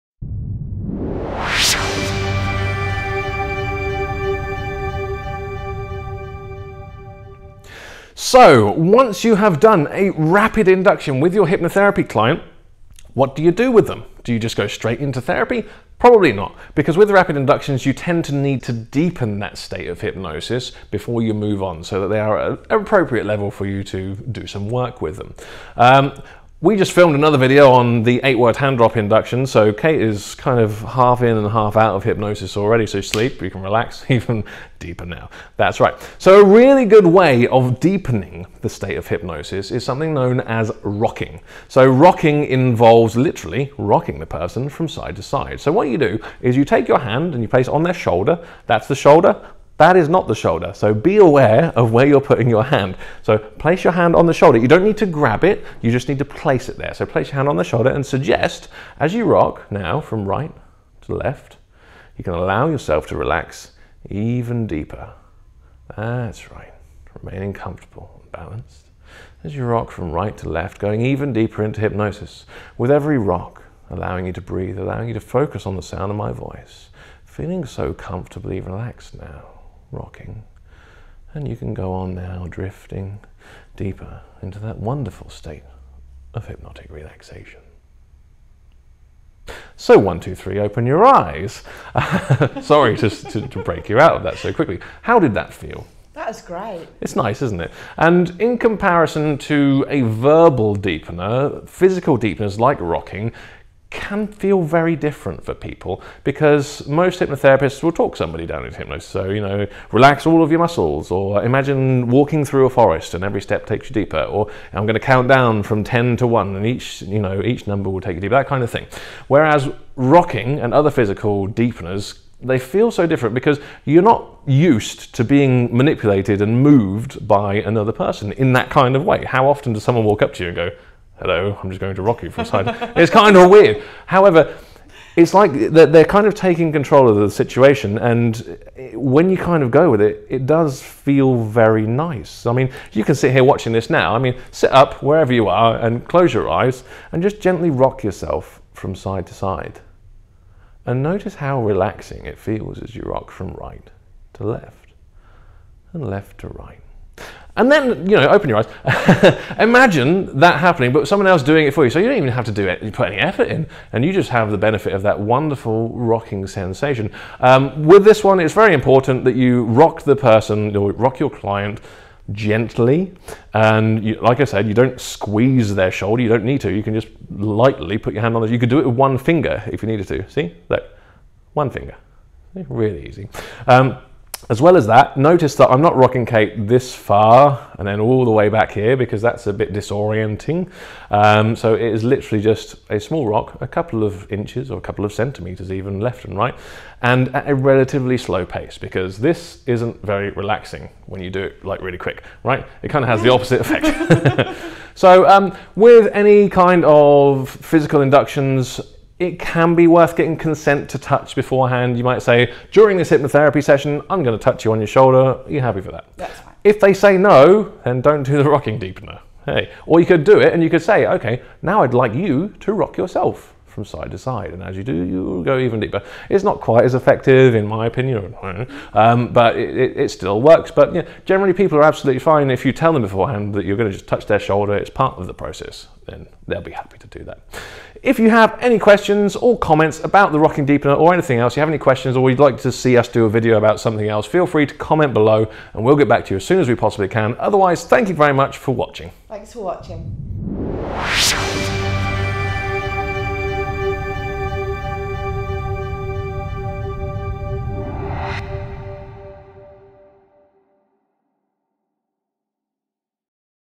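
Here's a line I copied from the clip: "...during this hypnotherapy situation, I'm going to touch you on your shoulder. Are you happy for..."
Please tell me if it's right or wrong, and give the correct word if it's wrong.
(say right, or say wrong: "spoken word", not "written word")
wrong: "session", not "situation".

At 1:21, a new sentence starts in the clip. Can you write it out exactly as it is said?
And you can go on now drifting deeper into that wonderful state of hypnotic relaxation.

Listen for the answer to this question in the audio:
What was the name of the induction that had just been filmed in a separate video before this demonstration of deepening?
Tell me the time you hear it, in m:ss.
0:28.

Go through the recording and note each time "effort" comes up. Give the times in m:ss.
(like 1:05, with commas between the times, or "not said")
2:43.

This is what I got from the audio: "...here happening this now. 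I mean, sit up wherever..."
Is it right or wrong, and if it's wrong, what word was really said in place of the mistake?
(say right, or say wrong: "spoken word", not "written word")
wrong: "watching", not "happening".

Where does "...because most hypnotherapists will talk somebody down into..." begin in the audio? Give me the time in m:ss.
1:46.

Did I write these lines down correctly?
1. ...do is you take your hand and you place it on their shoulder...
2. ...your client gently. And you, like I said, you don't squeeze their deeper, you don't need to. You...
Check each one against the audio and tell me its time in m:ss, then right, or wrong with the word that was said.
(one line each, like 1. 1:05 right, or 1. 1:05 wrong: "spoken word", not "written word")
1. 0:45 right
2. 2:51 wrong: "shoulder", not "deeper".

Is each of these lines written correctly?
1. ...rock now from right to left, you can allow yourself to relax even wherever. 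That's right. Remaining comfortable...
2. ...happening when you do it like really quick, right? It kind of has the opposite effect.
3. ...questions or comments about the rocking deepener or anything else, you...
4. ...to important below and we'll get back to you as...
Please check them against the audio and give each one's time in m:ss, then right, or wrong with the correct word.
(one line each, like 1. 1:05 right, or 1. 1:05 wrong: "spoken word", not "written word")
1. 0:59 wrong: "deeper", not "wherever"
2. 3:20 wrong: "relaxing", not "happening"
3. 3:58 right
4. 4:04 wrong: "comment", not "important".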